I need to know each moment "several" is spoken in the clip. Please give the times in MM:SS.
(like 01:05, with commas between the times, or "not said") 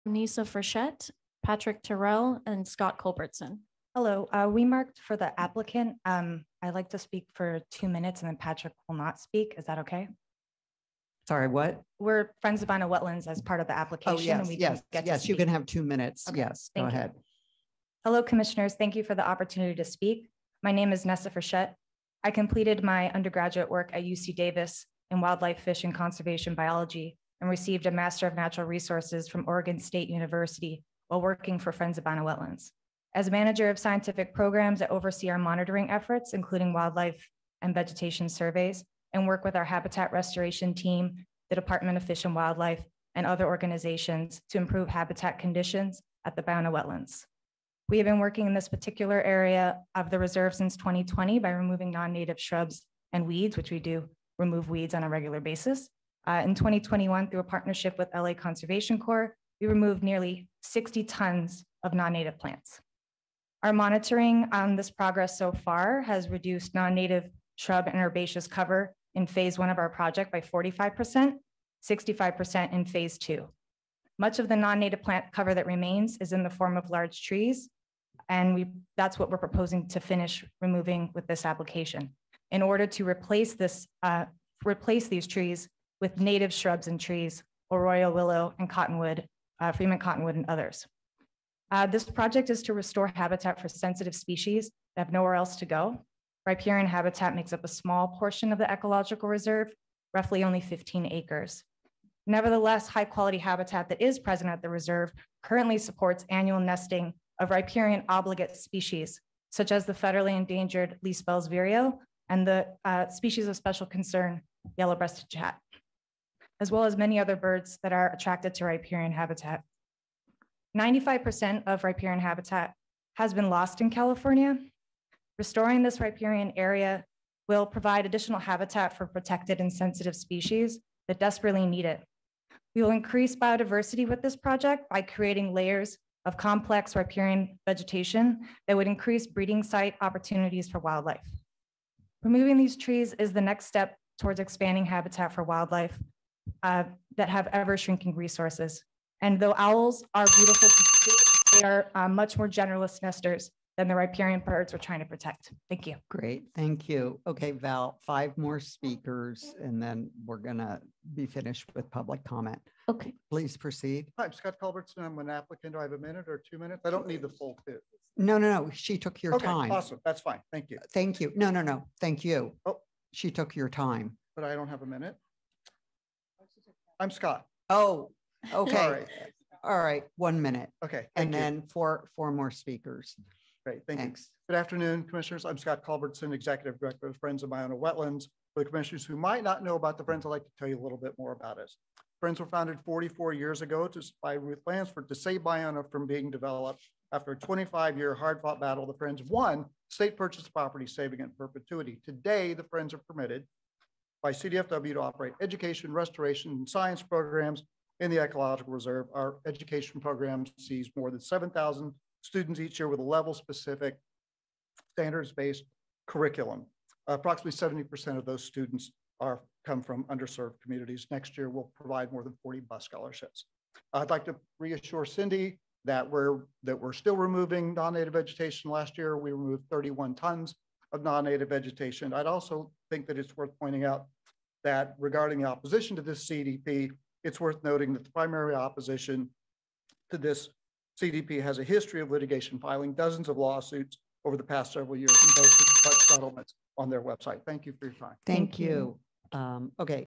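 04:04.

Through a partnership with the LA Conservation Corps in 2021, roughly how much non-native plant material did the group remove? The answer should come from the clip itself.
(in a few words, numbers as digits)
60 tons.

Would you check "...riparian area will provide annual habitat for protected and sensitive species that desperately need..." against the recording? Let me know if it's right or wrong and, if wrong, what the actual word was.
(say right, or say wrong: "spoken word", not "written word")
wrong: "additional", not "annual".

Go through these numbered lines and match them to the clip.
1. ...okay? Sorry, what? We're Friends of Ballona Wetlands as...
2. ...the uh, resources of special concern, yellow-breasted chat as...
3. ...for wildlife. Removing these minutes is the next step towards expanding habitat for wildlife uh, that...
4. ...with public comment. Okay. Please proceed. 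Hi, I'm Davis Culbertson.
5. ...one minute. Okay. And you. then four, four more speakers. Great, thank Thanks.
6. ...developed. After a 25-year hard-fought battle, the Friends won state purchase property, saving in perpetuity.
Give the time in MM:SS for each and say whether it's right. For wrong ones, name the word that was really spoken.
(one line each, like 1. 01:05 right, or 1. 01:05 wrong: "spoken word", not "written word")
1. 00:09 right
2. 01:52 wrong: "species", not "resources"
3. 02:20 wrong: "trees", not "minutes"
4. 02:41 wrong: "Scott", not "Davis"
5. 03:00 right
6. 03:16 right.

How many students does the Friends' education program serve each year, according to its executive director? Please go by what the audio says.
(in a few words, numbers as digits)
7,000.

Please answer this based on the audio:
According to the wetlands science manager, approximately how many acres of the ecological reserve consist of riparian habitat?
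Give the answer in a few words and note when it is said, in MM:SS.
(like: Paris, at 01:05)
15 acres, at 01:40.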